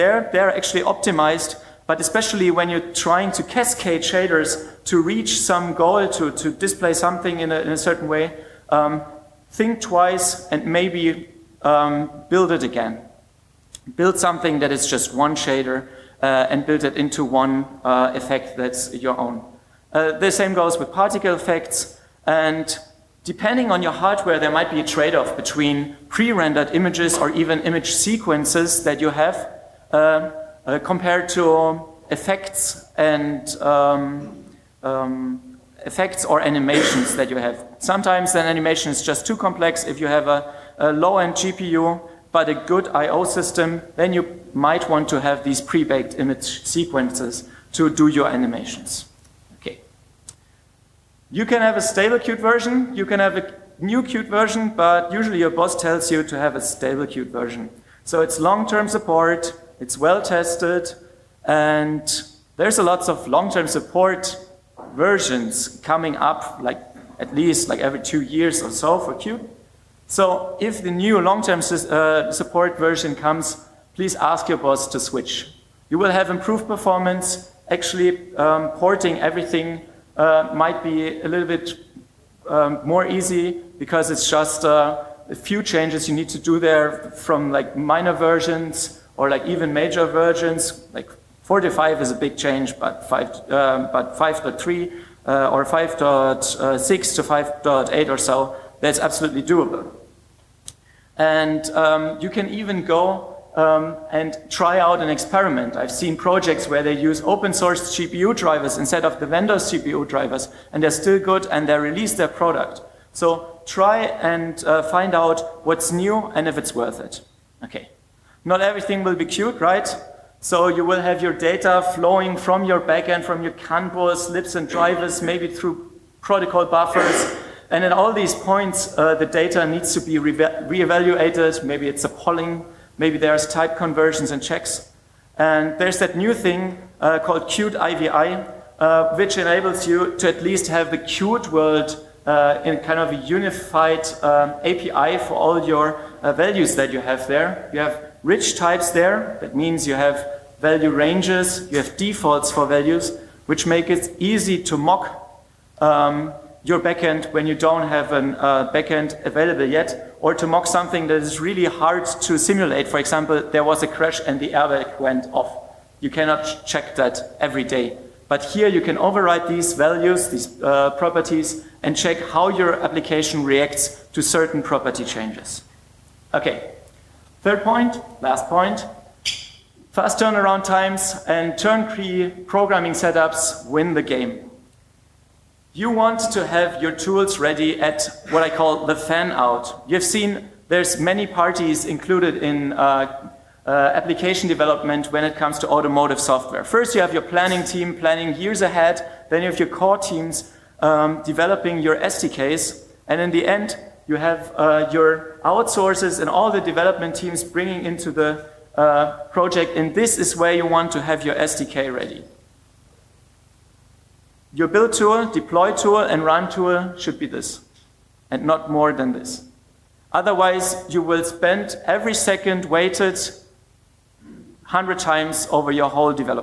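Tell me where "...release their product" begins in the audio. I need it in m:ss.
1:51.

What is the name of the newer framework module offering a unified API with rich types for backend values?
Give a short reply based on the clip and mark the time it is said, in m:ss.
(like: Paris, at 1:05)
Qt IVI, at 2:17.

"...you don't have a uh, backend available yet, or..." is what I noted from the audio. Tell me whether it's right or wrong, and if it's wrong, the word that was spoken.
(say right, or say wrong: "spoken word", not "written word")
right.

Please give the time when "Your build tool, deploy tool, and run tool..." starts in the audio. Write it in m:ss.
3:34.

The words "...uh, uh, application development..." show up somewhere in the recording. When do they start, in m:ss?
3:12.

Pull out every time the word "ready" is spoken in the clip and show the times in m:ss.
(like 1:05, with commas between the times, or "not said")
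3:07, 3:31.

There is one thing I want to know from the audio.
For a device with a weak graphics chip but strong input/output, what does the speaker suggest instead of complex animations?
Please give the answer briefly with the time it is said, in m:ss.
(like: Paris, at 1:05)
Pre-baked image sequences, at 0:45.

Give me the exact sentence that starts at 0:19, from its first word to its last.
Uh, the same goes with particle effects.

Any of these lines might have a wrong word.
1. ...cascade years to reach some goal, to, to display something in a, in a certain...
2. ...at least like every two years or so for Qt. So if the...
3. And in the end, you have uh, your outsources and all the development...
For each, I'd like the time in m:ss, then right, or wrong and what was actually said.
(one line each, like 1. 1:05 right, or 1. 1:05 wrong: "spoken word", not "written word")
1. 0:03 wrong: "shaders", not "years"
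2. 1:07 right
3. 3:23 right.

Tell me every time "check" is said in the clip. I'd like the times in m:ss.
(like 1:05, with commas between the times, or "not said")
2:14, 2:46, 2:51.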